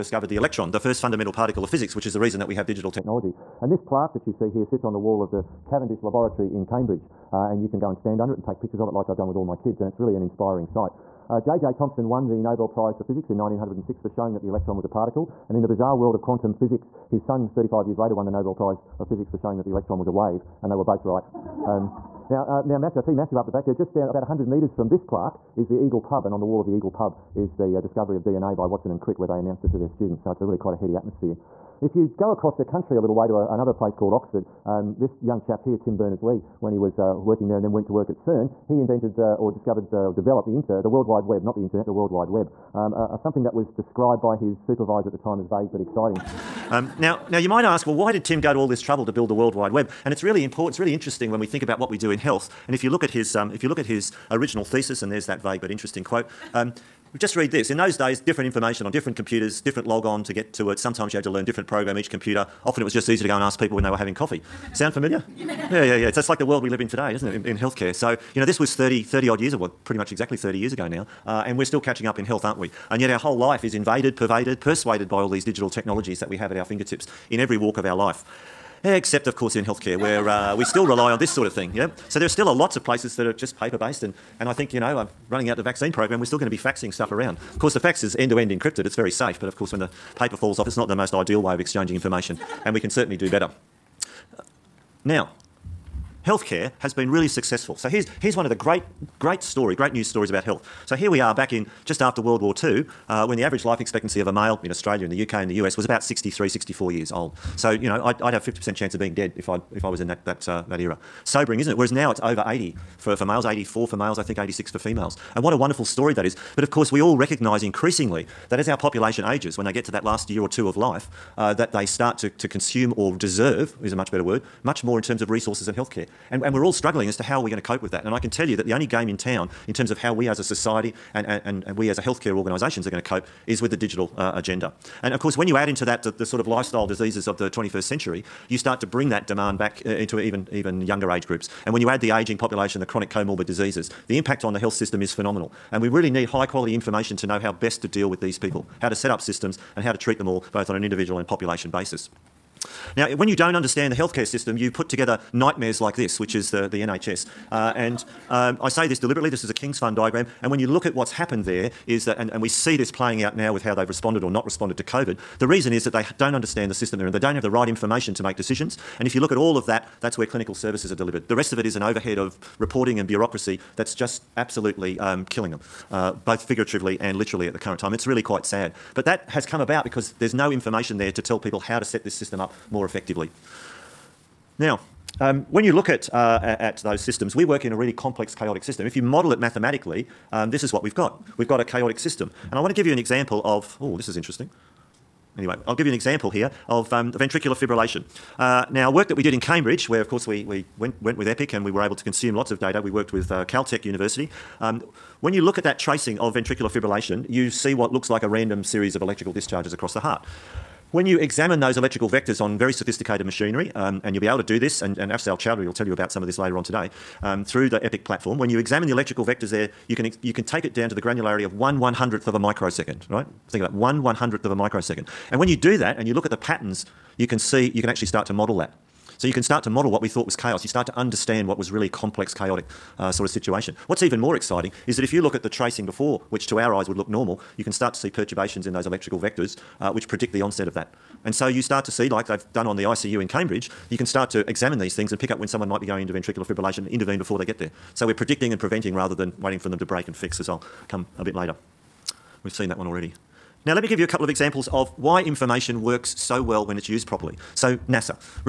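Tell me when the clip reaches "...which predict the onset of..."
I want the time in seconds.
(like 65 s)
239 s.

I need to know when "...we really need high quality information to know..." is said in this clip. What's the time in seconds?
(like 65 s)
145 s.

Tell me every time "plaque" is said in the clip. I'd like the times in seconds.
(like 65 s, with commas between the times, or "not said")
3 s, 25 s.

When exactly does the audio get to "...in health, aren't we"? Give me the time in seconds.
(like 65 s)
72 s.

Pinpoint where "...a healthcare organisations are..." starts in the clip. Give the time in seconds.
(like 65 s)
131 s.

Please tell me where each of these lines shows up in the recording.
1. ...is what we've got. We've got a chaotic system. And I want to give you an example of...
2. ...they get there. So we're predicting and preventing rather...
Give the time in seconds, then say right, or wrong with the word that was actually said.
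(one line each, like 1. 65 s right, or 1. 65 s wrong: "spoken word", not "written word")
1. 190 s right
2. 247 s right.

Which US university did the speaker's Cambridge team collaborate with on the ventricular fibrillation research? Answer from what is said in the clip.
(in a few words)
Caltech.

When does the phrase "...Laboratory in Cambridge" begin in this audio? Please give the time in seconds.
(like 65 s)
6 s.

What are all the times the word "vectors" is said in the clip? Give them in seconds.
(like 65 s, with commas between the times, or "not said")
212 s, 219 s, 239 s.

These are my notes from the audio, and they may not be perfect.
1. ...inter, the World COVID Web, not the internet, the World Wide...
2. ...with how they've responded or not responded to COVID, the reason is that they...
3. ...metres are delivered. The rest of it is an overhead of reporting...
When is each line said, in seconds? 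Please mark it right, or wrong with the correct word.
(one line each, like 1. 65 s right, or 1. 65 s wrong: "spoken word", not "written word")
1. 40 s wrong: "Wide", not "COVID"
2. 163 s right
3. 170 s wrong: "services", not "metres".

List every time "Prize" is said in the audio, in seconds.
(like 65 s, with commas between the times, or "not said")
12 s, 18 s.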